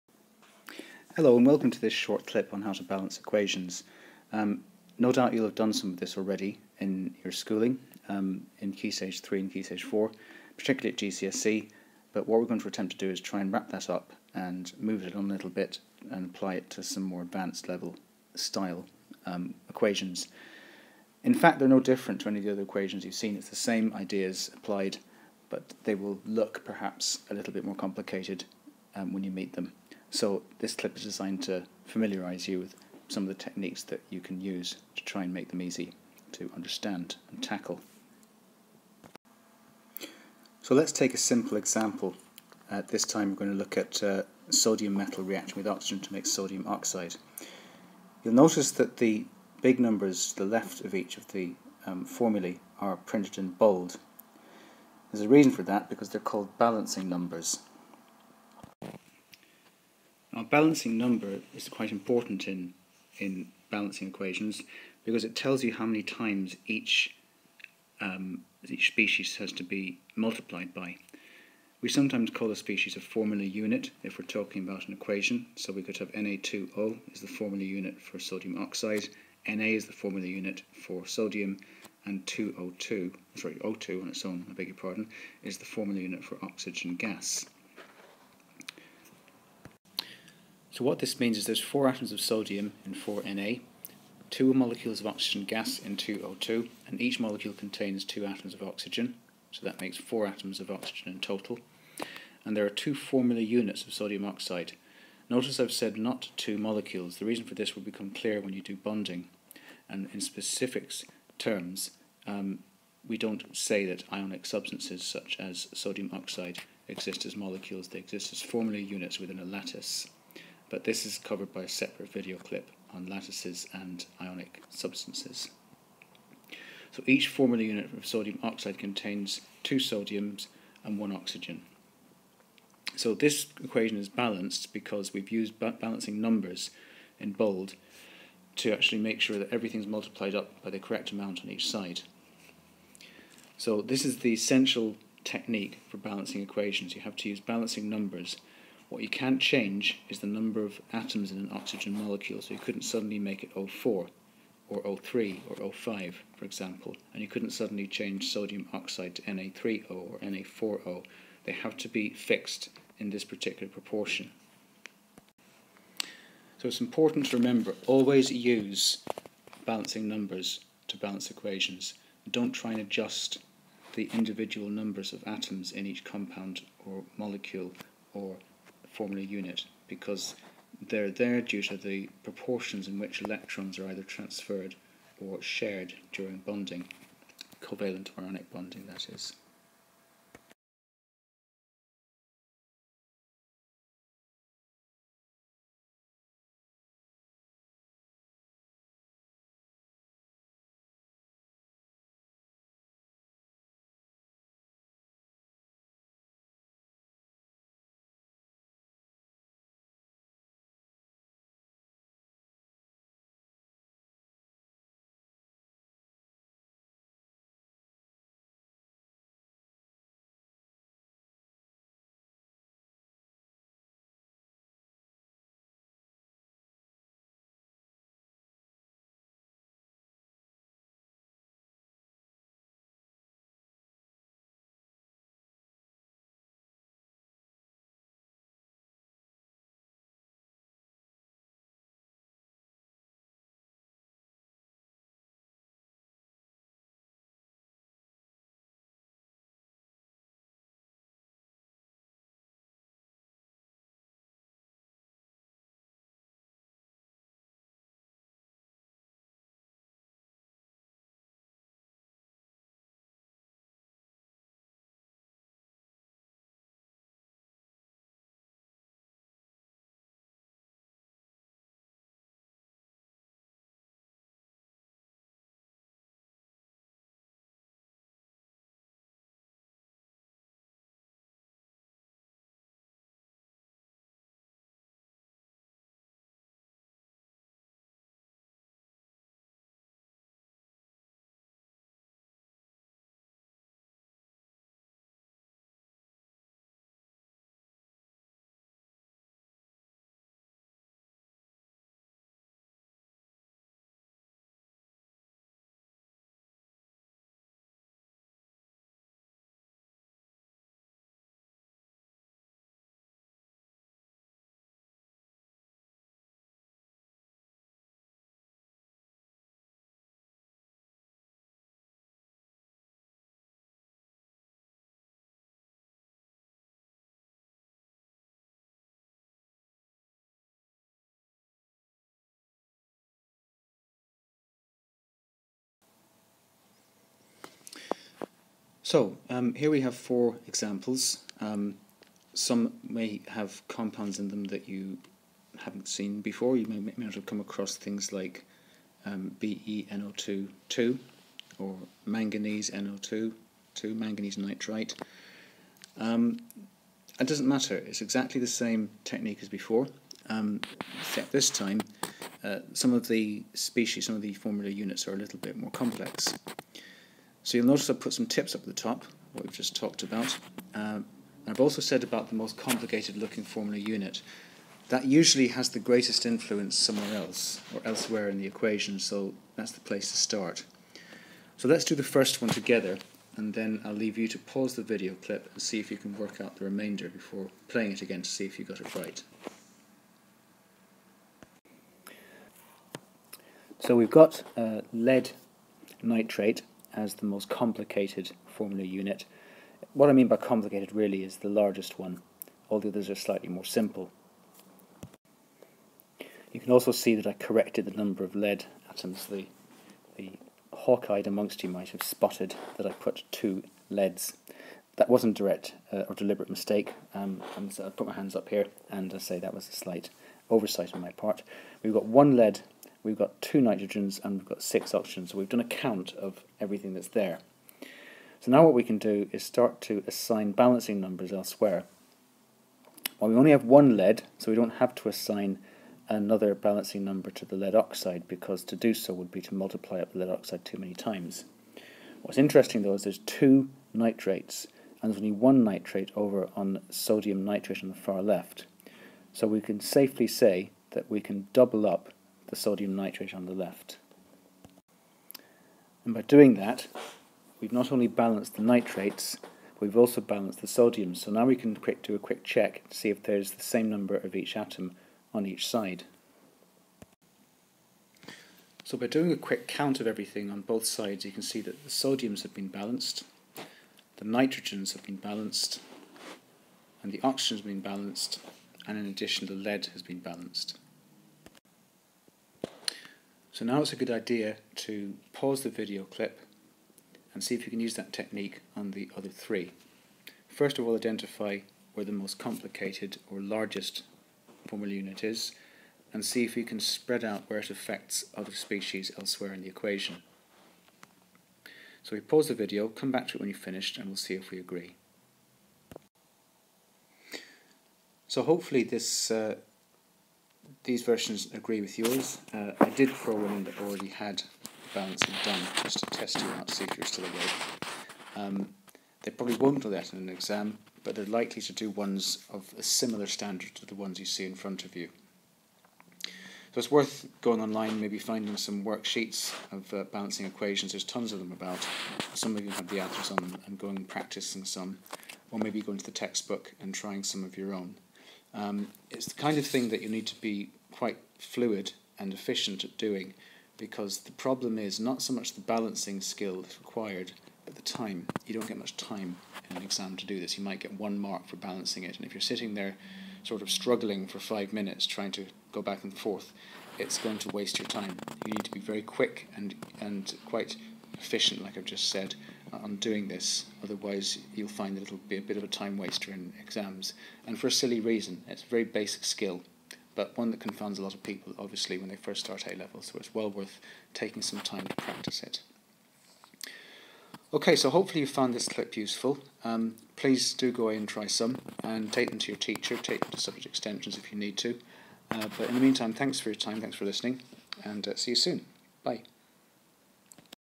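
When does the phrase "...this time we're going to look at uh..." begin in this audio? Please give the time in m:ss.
0:42.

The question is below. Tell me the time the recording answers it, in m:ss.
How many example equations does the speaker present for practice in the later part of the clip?
5:39.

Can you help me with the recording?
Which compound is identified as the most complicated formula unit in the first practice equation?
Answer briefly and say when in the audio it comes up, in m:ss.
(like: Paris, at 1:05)
lead nitrate, at 6:34.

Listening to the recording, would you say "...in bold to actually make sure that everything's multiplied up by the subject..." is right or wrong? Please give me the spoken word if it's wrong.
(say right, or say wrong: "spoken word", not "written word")
wrong: "correct", not "subject".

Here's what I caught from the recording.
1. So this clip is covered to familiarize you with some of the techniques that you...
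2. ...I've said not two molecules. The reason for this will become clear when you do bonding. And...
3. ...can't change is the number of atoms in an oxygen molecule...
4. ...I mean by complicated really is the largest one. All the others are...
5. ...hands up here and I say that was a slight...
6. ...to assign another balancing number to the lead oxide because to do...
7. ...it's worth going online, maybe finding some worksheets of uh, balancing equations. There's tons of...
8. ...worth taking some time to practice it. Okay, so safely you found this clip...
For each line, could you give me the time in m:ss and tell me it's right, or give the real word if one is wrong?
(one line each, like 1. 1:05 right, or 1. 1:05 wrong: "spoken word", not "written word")
1. 0:30 wrong: "designed", not "covered"
2. 1:45 right
3. 2:29 right
4. 6:40 right
5. 6:58 right
6. 7:14 right
7. 8:46 right
8. 9:33 wrong: "hopefully", not "safely".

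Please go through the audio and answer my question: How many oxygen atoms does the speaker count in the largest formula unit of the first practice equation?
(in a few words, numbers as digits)
6.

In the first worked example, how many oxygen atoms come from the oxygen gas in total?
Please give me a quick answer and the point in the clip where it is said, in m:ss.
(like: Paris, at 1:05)
4, at 1:39.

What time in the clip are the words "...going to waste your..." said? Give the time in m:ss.
9:17.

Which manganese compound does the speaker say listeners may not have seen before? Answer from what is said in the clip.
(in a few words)
manganese nitrite.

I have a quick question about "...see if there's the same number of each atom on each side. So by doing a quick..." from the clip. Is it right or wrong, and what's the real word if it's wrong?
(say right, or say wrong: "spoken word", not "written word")
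right.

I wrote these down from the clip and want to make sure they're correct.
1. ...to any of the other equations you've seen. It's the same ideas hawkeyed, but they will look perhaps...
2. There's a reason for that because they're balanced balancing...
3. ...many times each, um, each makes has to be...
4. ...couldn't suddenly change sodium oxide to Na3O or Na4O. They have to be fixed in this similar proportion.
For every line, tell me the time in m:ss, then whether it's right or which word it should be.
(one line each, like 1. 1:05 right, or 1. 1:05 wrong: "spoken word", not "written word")
1. 0:22 wrong: "applied", not "hawkeyed"
2. 0:55 wrong: "called", not "balanced"
3. 1:05 wrong: "species", not "makes"
4. 2:37 wrong: "particular", not "similar".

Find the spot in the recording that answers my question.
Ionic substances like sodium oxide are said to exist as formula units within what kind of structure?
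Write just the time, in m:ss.
1:59.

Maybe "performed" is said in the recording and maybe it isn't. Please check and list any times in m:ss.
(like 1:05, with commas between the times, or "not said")
not said.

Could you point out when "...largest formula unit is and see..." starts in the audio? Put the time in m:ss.
8:13.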